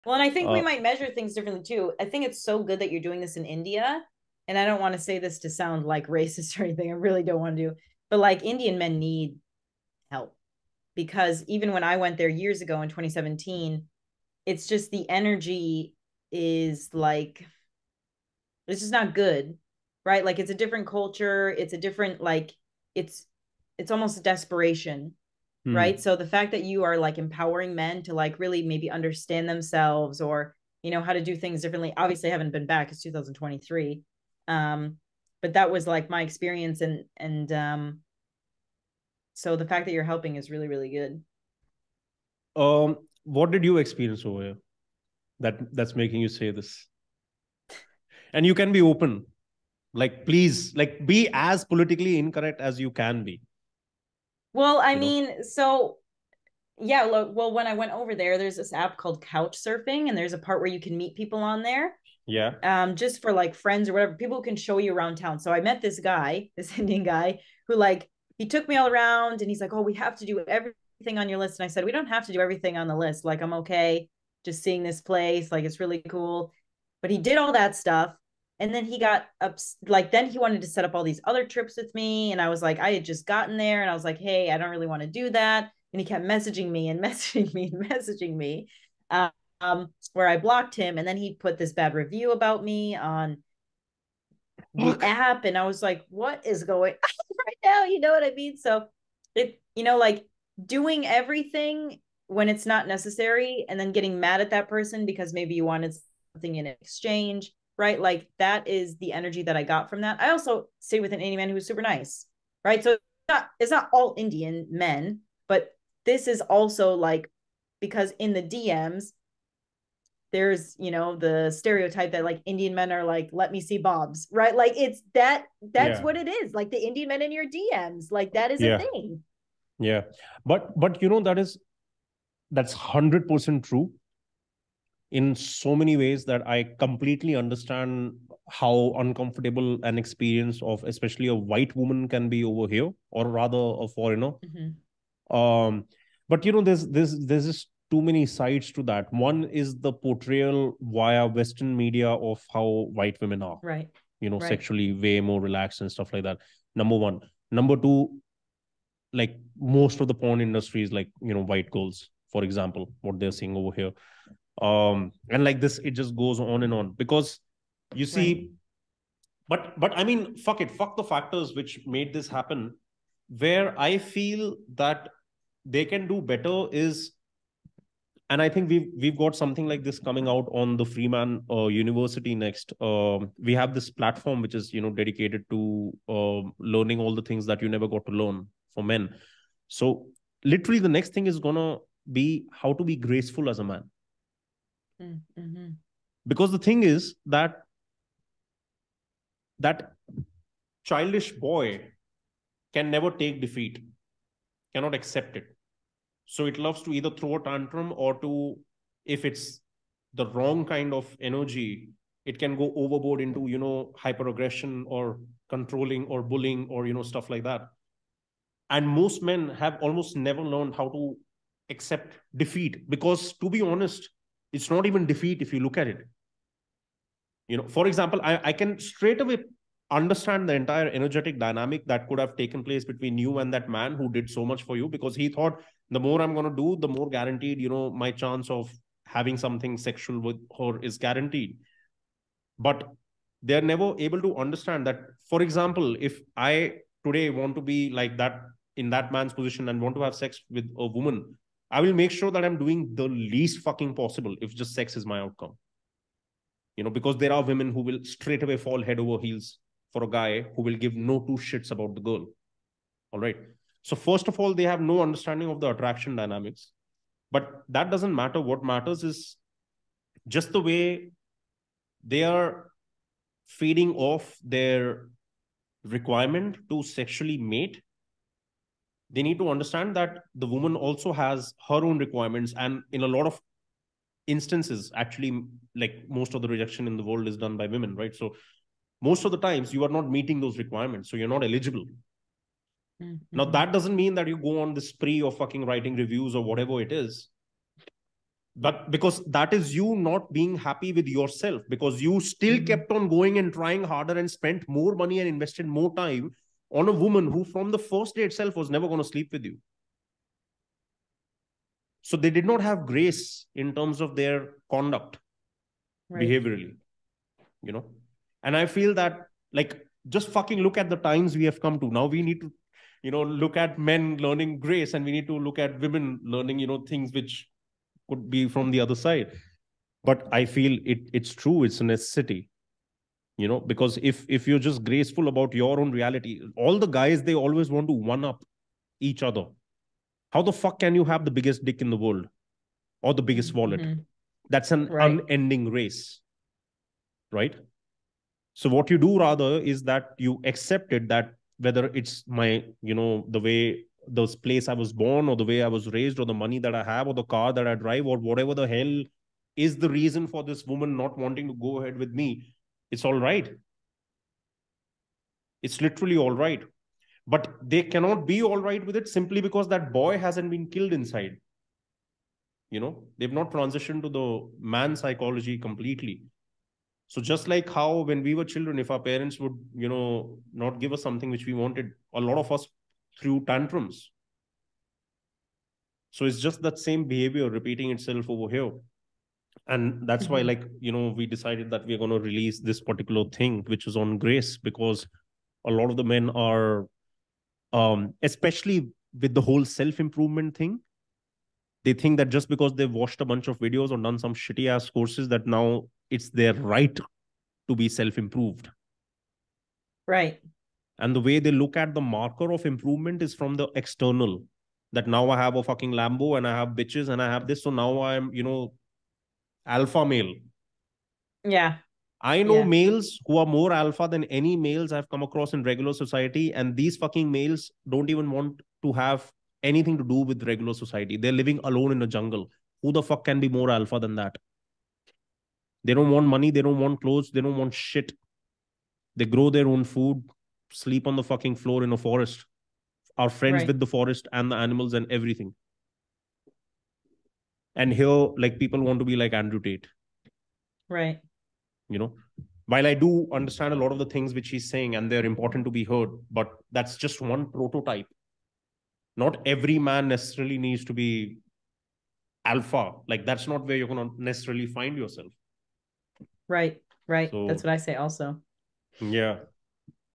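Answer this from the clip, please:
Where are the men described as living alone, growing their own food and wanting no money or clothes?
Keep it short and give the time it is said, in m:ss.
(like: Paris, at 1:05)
a jungle, at 7:12.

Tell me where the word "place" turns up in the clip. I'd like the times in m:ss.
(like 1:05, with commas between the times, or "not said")
1:15, 3:52, 5:54.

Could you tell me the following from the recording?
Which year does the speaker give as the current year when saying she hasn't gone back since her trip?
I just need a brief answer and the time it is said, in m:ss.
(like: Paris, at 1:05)
2023, at 0:33.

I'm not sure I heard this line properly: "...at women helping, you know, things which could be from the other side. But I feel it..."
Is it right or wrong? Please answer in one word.
wrong.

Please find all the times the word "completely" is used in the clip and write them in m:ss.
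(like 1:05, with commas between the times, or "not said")
2:16, 6:15.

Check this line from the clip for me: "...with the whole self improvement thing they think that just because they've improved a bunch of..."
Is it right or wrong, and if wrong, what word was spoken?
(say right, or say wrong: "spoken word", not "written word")
wrong: "watched", not "improved".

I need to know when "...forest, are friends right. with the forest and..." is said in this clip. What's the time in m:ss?
7:21.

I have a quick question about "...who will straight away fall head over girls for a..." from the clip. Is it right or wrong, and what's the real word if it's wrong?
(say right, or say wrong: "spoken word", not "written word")
wrong: "heels", not "girls".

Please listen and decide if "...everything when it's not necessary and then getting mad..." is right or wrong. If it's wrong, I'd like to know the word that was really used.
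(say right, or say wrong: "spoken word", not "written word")
right.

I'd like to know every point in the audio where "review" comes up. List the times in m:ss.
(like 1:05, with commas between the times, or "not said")
1:31, 4:55.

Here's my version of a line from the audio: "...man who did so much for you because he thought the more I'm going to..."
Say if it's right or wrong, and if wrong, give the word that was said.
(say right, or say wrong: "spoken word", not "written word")
right.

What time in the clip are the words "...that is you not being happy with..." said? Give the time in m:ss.
4:59.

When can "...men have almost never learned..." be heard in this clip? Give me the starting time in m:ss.
3:39.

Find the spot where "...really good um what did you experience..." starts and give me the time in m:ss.
0:40.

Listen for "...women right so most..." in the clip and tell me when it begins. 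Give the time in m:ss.
4:47.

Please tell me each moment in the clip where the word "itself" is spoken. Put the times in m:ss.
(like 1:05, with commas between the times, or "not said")
5:08, 6:27.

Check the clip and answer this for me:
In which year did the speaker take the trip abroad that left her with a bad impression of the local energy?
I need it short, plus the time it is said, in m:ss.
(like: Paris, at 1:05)
2017, at 0:12.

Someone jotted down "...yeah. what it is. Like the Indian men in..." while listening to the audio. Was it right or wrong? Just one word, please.
right.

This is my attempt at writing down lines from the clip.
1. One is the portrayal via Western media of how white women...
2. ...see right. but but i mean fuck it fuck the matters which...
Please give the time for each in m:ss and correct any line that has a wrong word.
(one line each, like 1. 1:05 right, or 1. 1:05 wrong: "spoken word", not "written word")
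1. 2:29 right
2. 2:48 wrong: "factors", not "matters".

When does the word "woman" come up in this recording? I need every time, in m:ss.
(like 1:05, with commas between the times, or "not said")
2:21, 4:10, 4:40, 5:06, 6:00.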